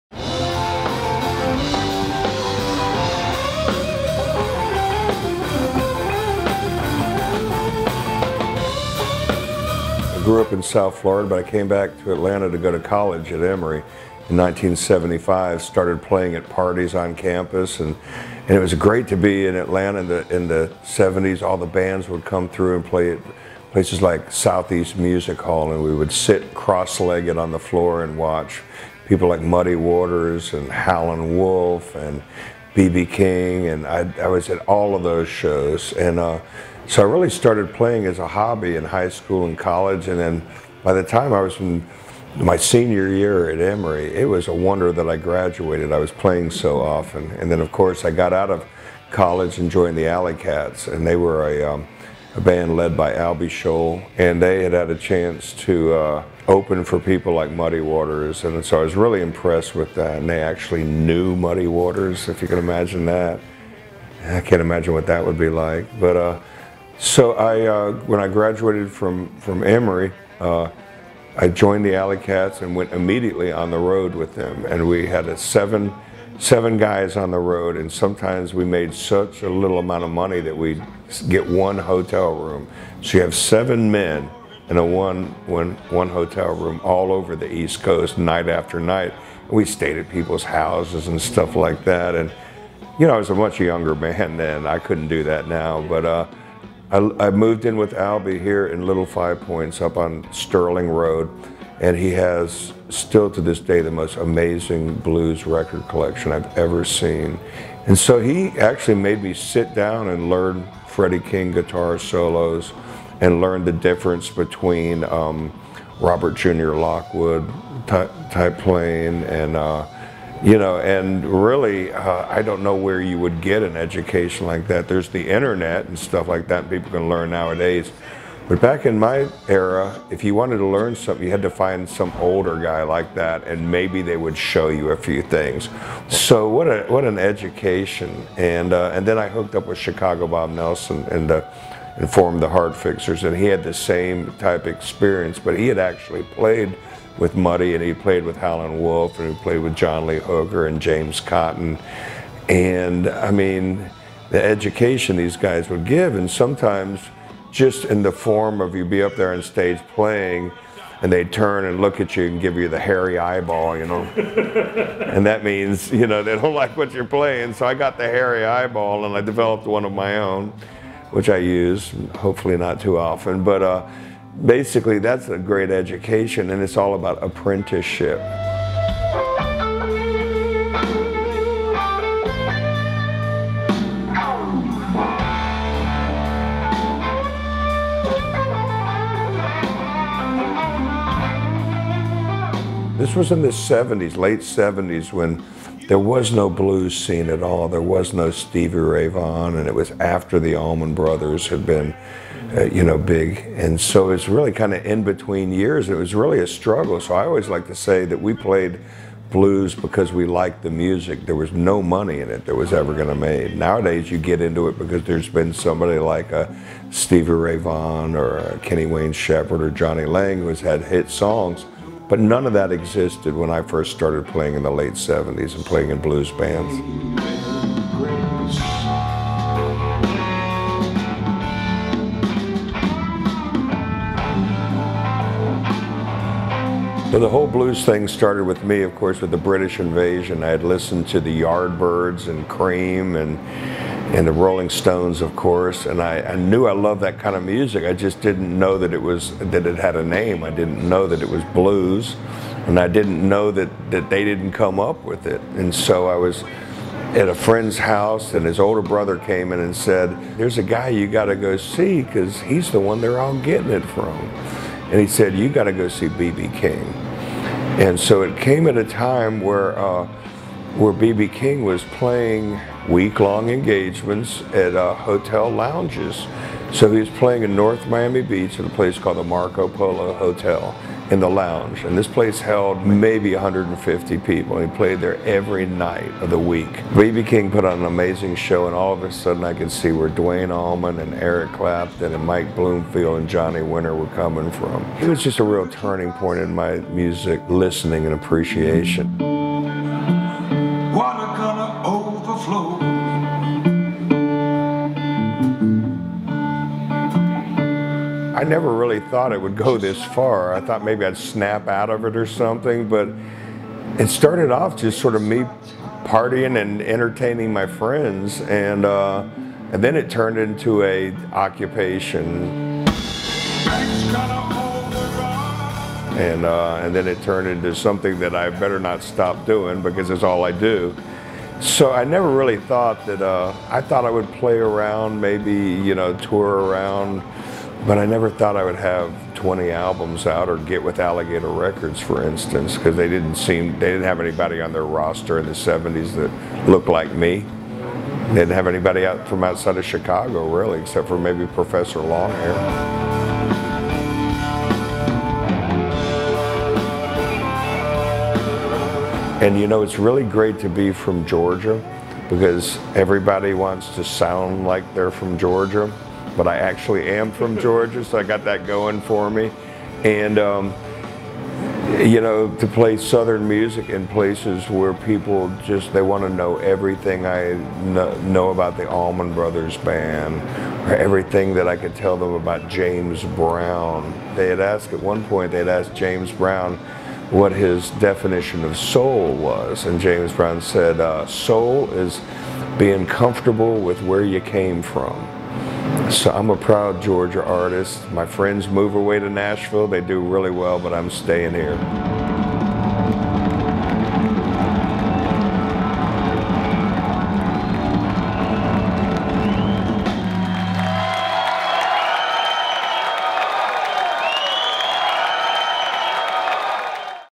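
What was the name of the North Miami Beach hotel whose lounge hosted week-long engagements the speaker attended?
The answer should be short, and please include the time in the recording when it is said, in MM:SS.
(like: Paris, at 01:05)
Marco Polo Hotel, at 04:39.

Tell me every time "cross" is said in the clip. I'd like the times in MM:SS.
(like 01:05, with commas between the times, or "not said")
00:26.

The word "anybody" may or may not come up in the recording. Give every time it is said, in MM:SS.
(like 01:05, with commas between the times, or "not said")
05:44, 05:48.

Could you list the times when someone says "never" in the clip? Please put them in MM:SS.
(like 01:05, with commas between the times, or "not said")
05:08, 05:32, 05:38.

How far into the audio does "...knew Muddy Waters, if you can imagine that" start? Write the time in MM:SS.
01:00.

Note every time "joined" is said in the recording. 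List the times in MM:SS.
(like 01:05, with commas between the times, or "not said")
00:49, 01:11.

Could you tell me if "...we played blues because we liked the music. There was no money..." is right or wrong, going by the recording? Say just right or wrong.
right.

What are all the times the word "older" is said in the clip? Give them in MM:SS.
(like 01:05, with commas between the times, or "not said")
02:12, 04:18.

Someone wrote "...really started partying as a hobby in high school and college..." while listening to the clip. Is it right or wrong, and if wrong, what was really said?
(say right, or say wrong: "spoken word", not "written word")
wrong: "playing", not "partying".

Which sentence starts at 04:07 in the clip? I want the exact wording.
I just didn't know that it was that it had a name.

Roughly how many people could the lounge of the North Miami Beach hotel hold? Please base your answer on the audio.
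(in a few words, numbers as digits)
150.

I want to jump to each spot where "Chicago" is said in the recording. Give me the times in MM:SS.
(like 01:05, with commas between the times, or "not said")
02:19, 05:49.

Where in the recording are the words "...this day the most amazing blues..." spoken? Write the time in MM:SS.
01:43.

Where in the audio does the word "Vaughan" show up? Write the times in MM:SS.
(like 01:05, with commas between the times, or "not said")
03:19, 03:37.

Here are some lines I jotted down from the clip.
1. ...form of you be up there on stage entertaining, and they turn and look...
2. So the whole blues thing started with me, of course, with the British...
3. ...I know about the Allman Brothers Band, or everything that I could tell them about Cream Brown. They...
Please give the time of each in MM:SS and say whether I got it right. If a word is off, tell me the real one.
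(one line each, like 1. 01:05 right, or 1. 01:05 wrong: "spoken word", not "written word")
1. 02:38 wrong: "playing", not "entertaining"
2. 03:57 right
3. 06:17 wrong: "James", not "Cream".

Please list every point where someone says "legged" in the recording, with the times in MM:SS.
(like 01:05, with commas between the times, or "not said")
00:26.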